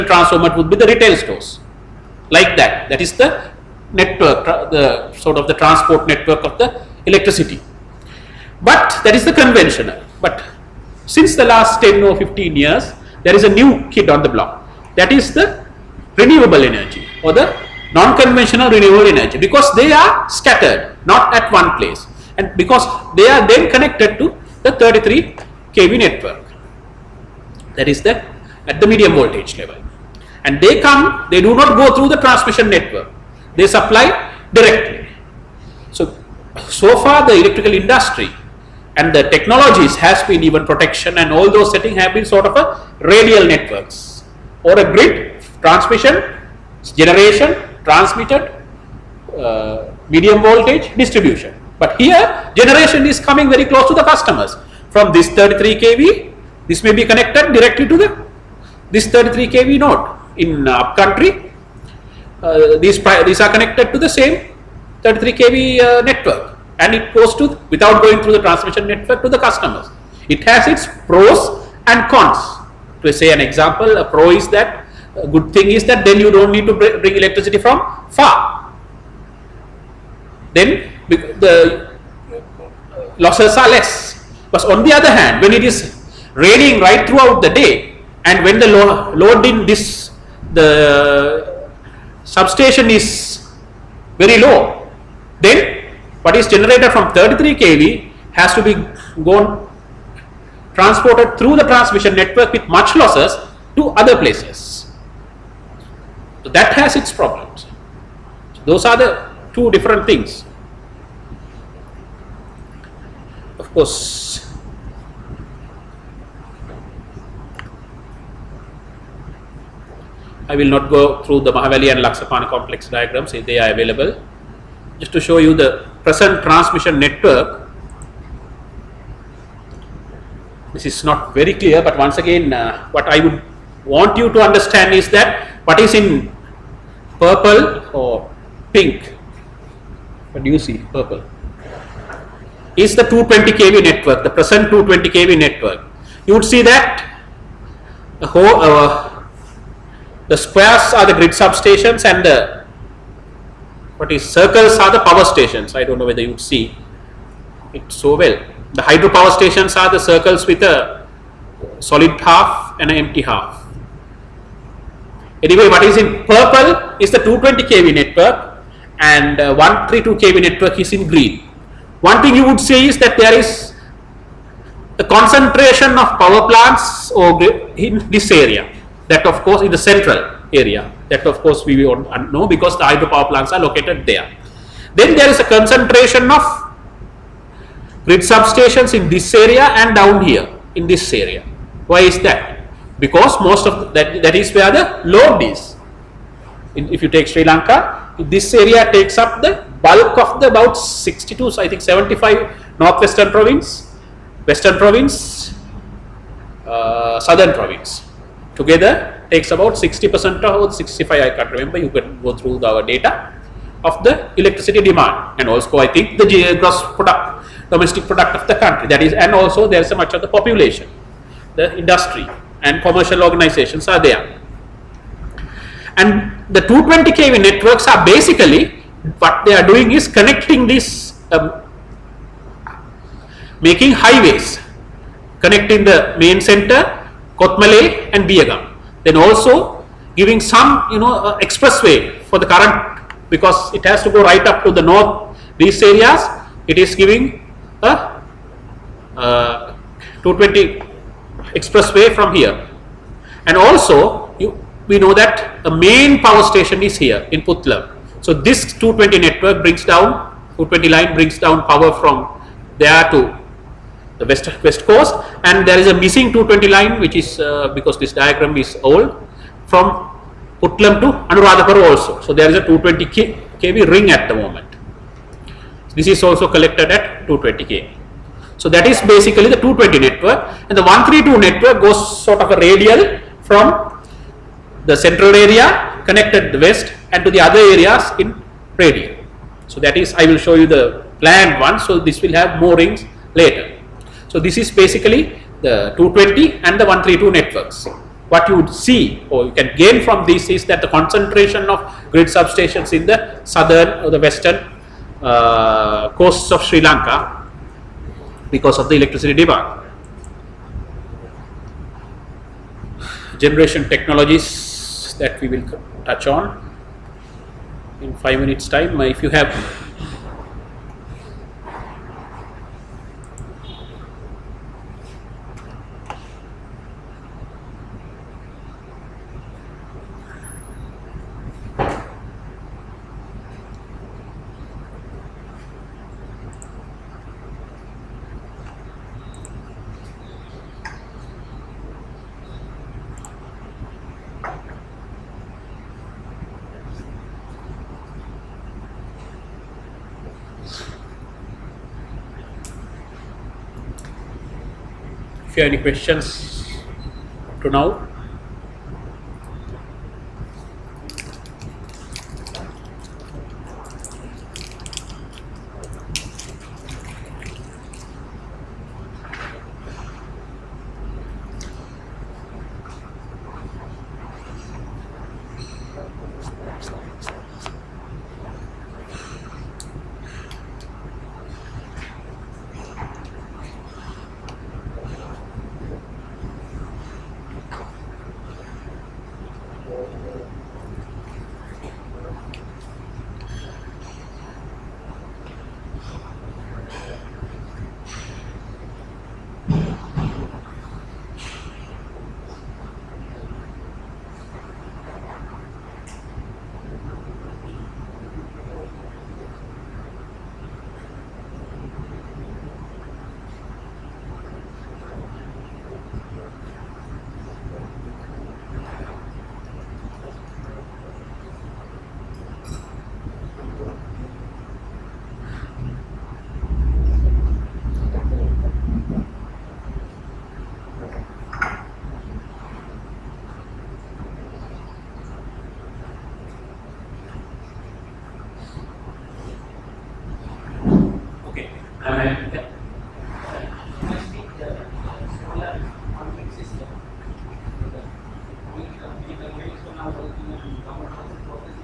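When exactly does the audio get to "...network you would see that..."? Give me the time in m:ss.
2:25.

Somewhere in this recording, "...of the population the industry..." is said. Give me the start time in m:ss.
3:40.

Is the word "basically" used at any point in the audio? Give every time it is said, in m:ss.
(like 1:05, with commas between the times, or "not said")
3:48, 4:38, 4:54.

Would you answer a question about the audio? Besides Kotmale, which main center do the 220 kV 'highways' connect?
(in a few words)
Biagam.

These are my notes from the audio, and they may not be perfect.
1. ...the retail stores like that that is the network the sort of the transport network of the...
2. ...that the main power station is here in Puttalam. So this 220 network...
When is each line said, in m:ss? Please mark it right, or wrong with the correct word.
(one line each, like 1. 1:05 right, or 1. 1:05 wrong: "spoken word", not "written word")
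1. 0:00 right
2. 4:15 right.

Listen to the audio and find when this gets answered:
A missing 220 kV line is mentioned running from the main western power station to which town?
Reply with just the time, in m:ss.
4:31.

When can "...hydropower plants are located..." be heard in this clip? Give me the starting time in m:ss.
3:02.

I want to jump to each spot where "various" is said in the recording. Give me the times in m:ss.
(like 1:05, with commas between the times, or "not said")
not said.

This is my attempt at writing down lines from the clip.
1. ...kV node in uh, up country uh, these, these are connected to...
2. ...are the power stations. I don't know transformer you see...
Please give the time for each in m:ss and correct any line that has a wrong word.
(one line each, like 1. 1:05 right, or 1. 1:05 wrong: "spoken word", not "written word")
1. 0:59 right
2. 2:34 wrong: "whether", not "transformer".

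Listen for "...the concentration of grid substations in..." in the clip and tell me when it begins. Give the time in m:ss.
5:00.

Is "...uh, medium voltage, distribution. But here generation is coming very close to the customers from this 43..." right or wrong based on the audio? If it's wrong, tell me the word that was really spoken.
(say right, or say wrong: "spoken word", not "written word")
wrong: "33", not "43".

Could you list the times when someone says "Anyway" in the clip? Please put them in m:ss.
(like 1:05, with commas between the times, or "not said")
2:45.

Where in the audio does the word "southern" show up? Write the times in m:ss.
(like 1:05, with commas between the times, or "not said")
3:27, 5:03.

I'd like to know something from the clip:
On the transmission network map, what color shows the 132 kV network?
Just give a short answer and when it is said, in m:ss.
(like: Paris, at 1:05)
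Green, at 2:51.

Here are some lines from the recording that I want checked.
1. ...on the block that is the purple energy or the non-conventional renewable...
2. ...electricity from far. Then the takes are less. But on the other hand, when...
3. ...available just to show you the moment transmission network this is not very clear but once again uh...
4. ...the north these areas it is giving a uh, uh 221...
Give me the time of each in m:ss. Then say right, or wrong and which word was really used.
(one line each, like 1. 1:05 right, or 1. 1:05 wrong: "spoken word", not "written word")
1. 0:14 wrong: "renewable", not "purple"
2. 1:17 wrong: "losses", not "takes"
3. 2:03 wrong: "present", not "moment"
4. 4:04 wrong: "220", not "221".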